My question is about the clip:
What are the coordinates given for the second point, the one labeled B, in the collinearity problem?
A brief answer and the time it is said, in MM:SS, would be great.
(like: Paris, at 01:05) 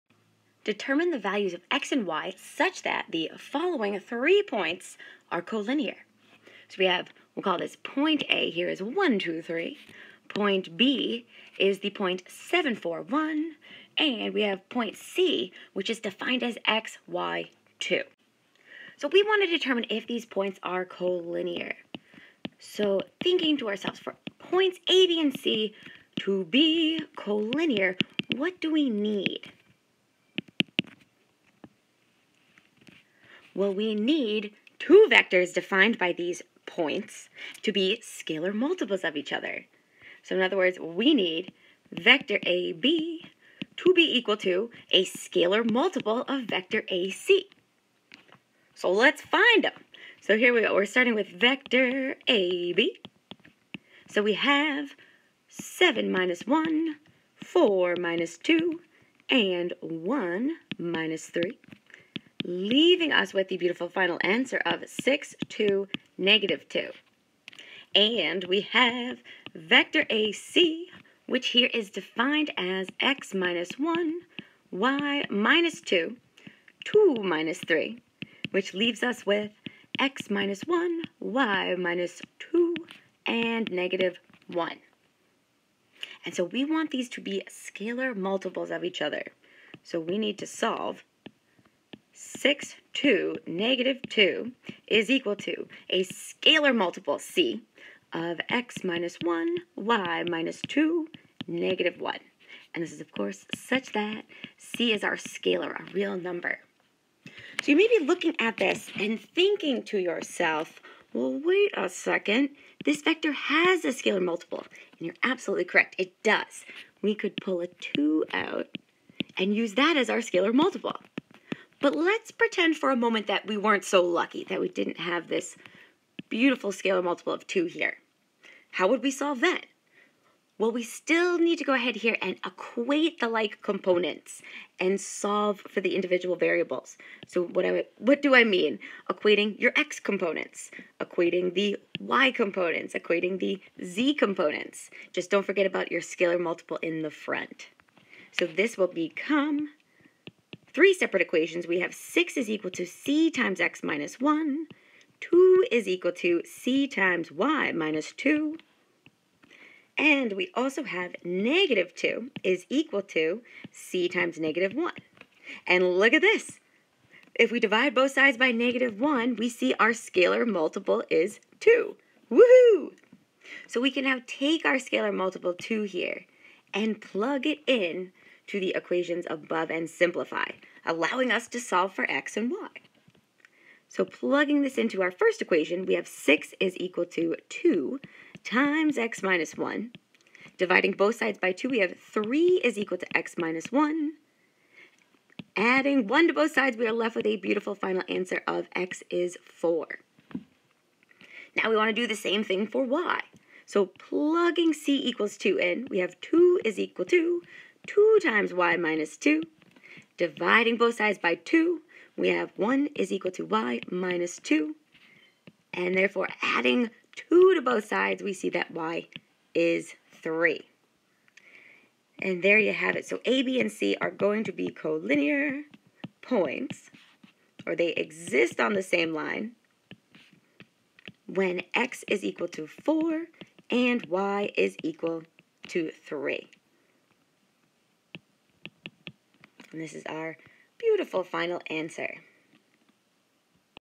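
7, 4, 1, at 00:12.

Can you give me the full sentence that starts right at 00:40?
So in other words, we need vector AB to be equal to a scalar multiple of vector AC.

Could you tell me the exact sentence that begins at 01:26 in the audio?
And so we want these to be scalar multiples of each other.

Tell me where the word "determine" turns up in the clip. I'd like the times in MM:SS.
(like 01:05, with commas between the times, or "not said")
00:00, 00:19.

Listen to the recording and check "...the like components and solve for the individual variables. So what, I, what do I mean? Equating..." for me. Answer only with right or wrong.
right.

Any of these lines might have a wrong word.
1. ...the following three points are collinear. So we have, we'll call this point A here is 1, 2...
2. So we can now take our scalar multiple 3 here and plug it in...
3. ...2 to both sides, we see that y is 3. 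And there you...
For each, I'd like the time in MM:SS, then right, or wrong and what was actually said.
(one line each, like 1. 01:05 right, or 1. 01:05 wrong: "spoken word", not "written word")
1. 00:03 right
2. 02:53 wrong: "2", not "3"
3. 03:37 right.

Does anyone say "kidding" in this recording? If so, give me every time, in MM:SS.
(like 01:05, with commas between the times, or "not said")
not said.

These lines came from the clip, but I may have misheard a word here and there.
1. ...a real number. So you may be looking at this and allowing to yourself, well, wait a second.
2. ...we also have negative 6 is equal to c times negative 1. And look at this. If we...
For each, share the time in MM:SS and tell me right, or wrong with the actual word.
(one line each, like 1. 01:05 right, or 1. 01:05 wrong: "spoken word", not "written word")
1. 01:45 wrong: "thinking", not "allowing"
2. 02:40 wrong: "2", not "6".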